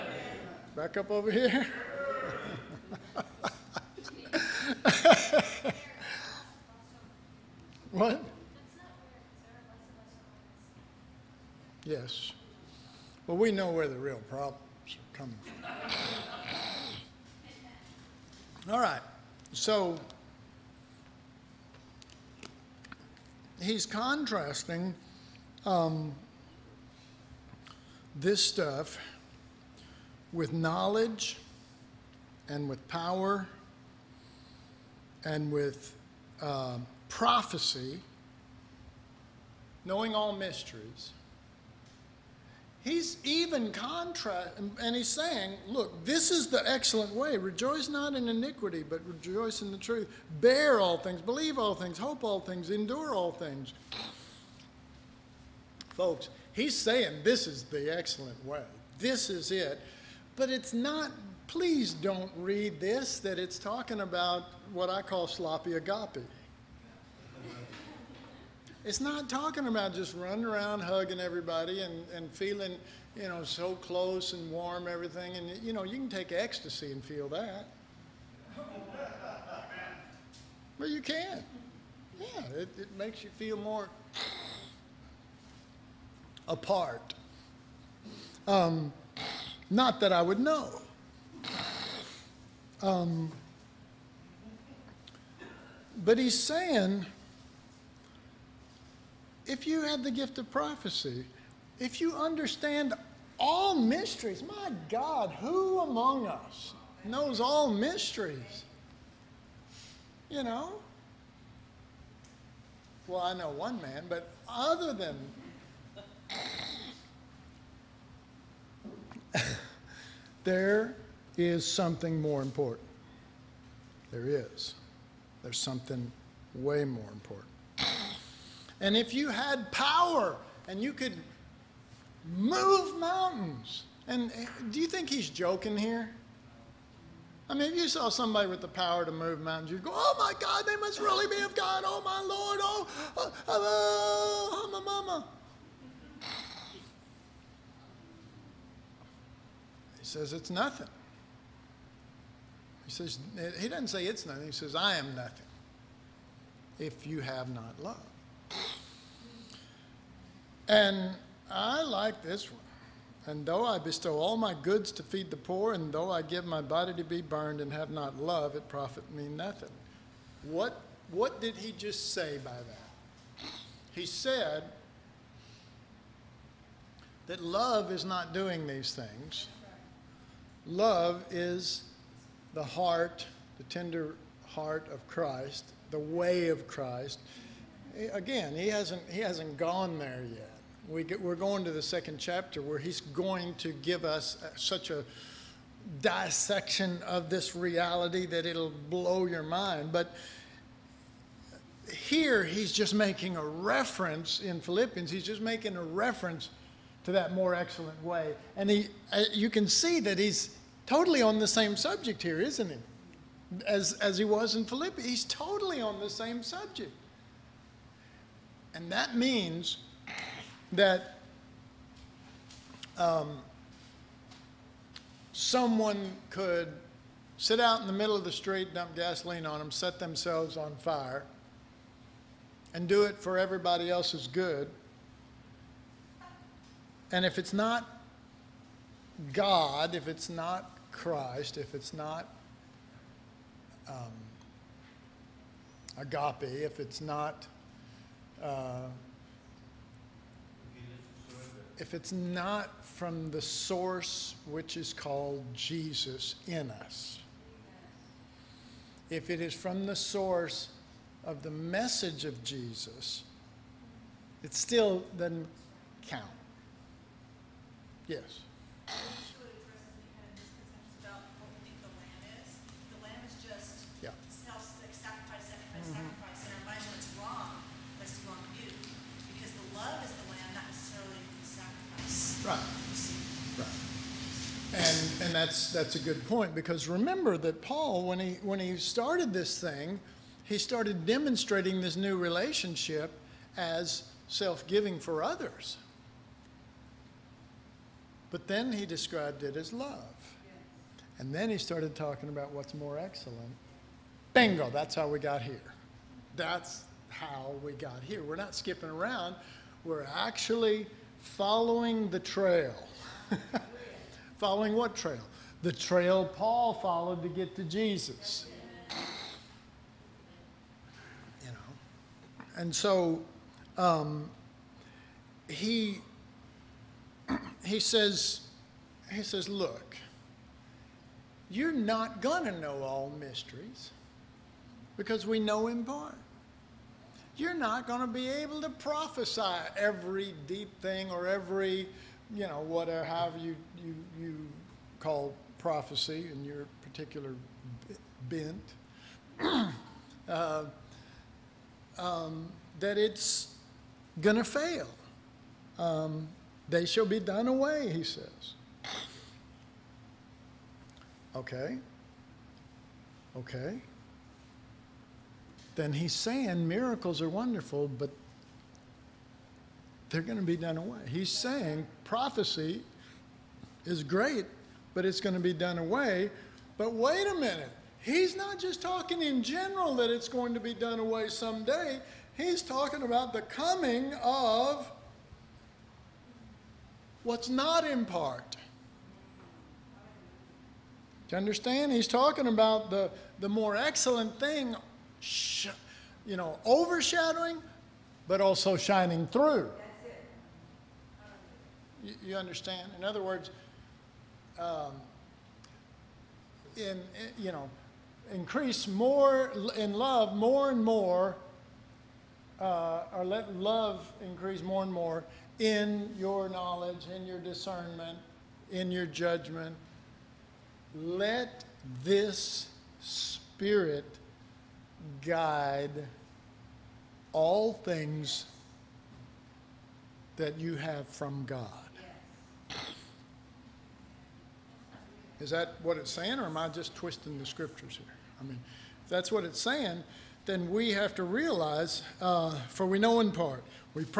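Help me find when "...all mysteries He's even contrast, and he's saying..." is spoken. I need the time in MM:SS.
00:40.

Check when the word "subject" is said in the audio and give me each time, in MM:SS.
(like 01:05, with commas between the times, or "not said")
03:31, 03:36.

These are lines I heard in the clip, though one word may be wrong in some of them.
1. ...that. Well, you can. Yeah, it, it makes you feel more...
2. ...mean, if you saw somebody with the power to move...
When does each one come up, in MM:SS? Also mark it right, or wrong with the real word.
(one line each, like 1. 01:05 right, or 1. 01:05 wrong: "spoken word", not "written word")
1. 01:17 right
2. 02:17 right.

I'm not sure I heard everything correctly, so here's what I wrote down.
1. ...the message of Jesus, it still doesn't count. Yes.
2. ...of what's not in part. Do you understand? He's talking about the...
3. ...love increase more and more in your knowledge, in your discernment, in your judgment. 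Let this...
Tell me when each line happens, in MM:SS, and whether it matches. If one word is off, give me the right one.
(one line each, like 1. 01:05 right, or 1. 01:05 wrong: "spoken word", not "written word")
1. 04:21 right
2. 06:24 right
3. 06:53 right.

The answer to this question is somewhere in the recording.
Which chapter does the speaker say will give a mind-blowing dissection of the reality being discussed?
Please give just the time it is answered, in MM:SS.
03:11.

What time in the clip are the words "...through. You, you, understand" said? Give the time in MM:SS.
06:39.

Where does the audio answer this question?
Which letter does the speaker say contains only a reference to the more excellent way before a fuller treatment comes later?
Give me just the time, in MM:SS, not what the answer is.
03:24.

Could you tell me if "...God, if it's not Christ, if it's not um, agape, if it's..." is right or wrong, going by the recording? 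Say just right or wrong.
right.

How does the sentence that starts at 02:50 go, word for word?
What, what did he just say by that?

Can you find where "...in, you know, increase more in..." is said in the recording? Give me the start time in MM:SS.
06:46.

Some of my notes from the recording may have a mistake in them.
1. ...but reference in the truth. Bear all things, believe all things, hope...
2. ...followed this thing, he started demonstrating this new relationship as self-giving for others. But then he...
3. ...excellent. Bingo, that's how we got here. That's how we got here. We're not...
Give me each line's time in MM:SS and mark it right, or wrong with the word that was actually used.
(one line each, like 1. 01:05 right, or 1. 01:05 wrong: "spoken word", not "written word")
1. 00:48 wrong: "rejoice", not "reference"
2. 04:48 wrong: "started", not "followed"
3. 05:02 right.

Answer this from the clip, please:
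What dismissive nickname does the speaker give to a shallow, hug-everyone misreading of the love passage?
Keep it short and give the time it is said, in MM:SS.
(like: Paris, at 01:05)
sloppy agape, at 01:05.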